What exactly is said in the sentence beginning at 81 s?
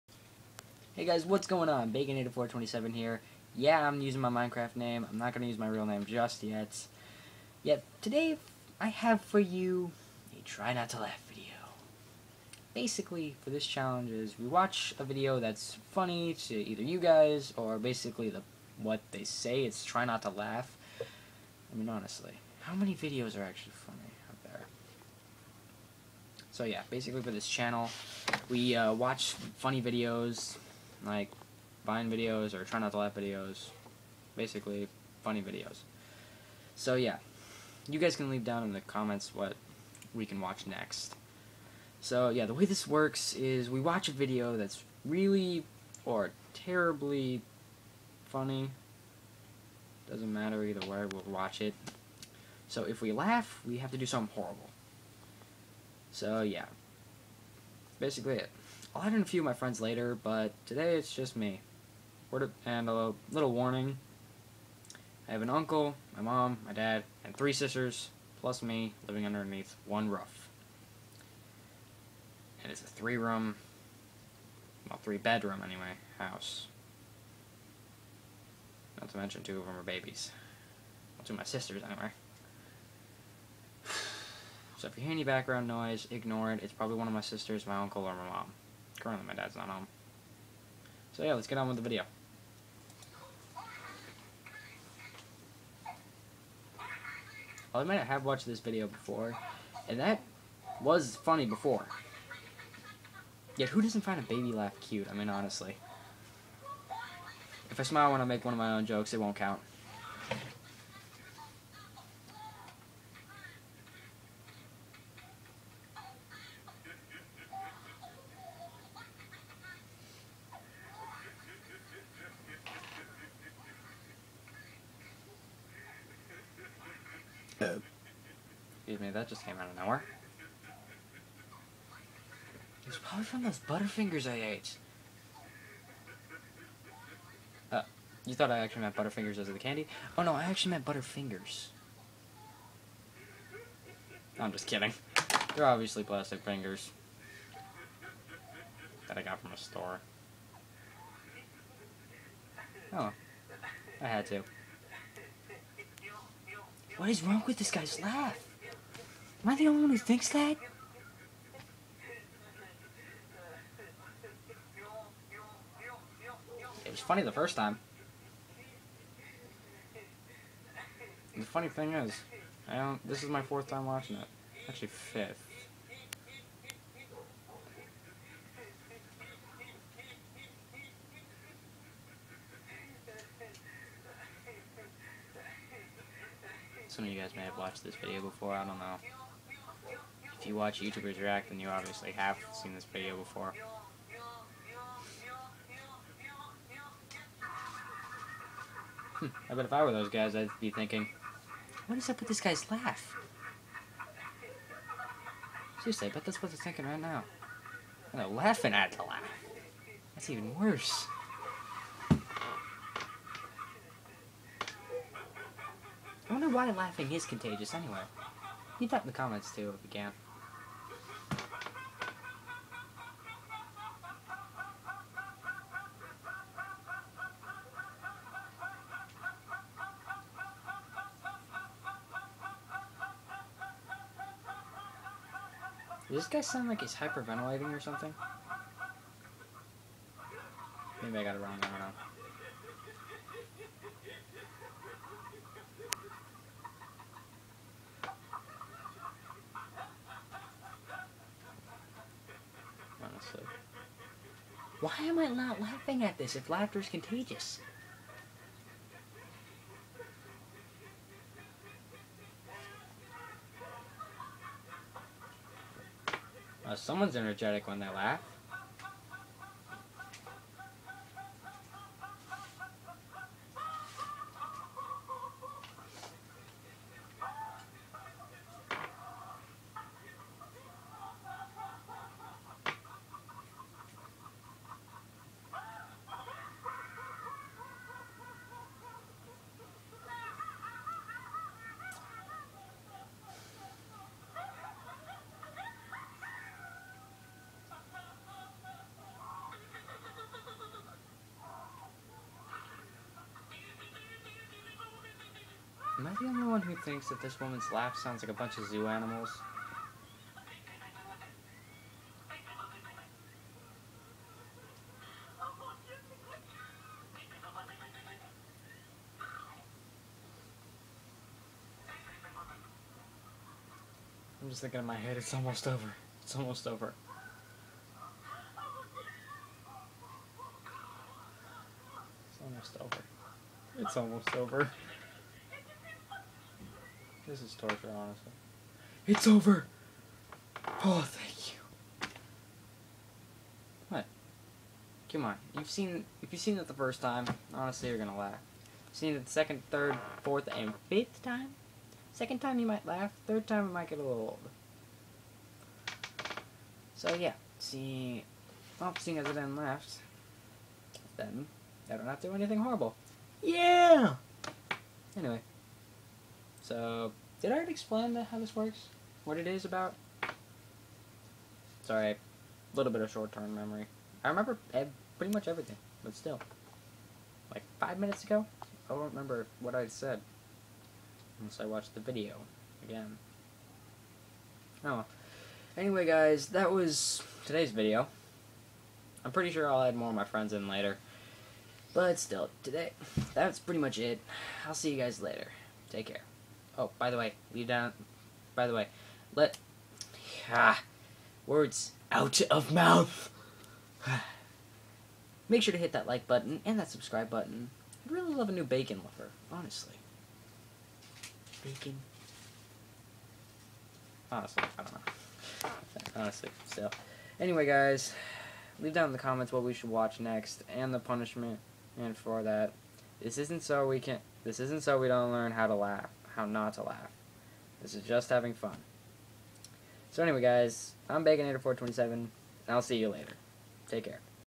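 Well, two of my sisters, anyway.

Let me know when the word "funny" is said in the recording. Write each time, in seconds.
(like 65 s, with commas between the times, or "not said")
15 s, 23 s, 29 s, 35 s, 48 s, 101 s, 166 s, 171 s.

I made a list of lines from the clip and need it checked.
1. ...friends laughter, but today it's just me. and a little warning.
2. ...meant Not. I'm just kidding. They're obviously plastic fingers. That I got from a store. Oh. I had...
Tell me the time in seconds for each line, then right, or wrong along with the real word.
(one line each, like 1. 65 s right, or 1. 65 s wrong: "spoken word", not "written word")
1. 59 s wrong: "later", not "laughter"
2. 140 s wrong: "Butterfingers", not "Not".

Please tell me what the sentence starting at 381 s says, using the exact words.
Unless I watched the video again.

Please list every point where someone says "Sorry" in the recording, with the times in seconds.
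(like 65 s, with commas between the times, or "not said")
371 s.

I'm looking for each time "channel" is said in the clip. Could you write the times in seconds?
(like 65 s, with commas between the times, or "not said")
27 s.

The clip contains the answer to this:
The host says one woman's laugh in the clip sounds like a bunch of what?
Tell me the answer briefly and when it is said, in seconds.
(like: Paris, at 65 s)
Zoo animals, at 308 s.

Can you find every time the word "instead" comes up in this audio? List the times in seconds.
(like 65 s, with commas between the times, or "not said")
not said.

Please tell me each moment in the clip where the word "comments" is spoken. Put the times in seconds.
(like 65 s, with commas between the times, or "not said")
38 s, 219 s, 419 s.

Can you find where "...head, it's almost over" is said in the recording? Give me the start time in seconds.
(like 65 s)
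324 s.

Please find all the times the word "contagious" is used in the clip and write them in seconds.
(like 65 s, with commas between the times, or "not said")
217 s, 256 s.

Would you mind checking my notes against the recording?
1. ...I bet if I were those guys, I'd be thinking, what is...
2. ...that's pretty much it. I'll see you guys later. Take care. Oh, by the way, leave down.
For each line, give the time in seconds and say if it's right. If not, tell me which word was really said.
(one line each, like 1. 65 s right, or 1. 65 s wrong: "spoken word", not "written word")
1. 199 s right
2. 393 s right.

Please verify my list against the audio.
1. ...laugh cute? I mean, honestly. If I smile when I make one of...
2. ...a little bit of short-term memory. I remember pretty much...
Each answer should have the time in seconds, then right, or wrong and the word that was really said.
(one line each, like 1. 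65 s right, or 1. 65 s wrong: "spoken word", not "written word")
1. 104 s right
2. 372 s right.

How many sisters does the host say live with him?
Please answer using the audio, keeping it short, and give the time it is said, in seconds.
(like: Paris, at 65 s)
Three, at 67 s.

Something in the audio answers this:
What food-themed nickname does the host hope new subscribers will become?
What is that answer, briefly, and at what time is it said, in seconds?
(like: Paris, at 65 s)
A new bacon lover, at 408 s.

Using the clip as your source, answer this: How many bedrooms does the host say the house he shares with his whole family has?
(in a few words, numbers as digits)
Three.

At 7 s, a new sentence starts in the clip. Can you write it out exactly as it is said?
Yet, today I have for you a try not to laugh video.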